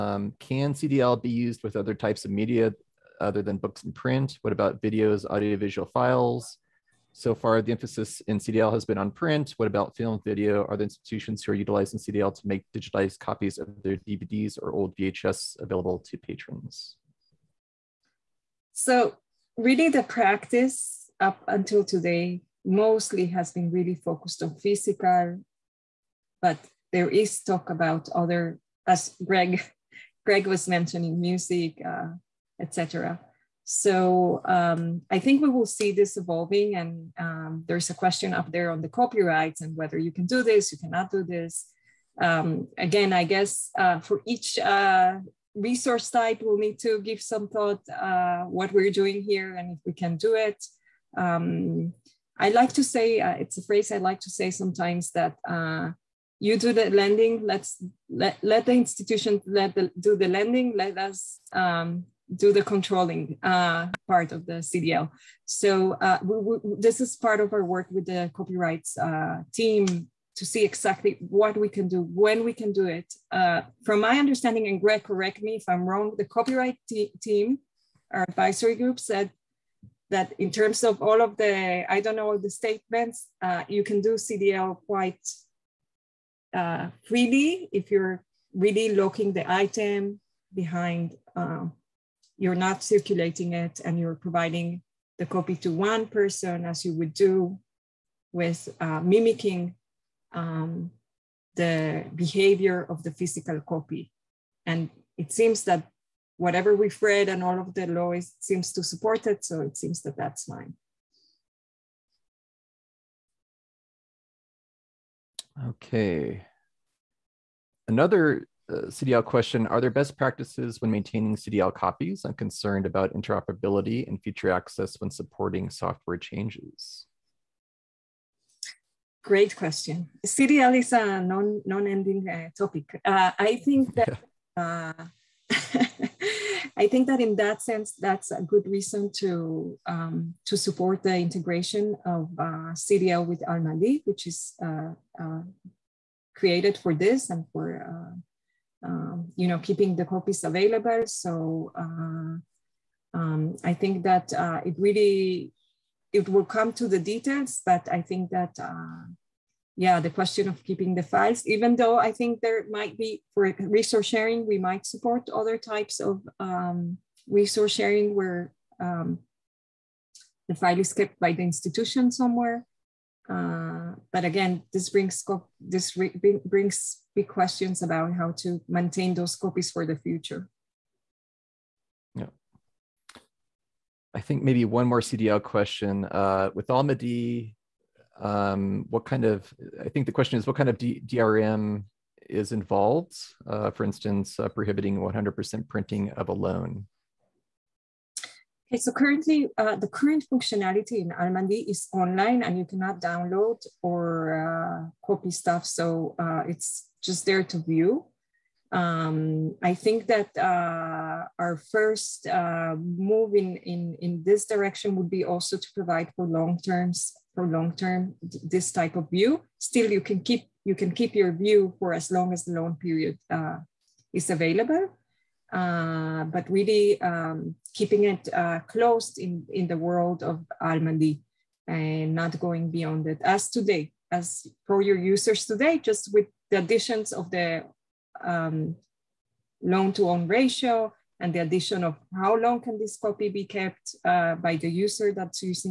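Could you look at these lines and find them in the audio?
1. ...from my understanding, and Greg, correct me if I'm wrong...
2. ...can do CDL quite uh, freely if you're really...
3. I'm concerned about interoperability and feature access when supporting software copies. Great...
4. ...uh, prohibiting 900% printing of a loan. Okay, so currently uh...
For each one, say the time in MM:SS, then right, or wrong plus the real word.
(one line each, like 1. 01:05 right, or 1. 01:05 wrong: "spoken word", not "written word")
1. 01:13 right
2. 01:23 right
3. 02:02 wrong: "changes", not "copies"
4. 03:14 wrong: "100", not "900".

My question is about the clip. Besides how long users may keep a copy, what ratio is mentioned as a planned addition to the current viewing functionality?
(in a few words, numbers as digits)
loan to own ratio.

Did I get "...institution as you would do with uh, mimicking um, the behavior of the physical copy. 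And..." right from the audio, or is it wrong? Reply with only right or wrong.
wrong.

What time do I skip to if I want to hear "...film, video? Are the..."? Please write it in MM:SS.
00:09.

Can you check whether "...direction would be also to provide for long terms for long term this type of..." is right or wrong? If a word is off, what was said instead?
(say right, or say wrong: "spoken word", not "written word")
right.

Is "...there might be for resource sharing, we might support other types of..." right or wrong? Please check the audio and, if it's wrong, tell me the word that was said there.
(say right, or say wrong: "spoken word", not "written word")
right.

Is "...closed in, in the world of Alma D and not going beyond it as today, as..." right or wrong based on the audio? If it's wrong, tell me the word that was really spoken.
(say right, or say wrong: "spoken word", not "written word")
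right.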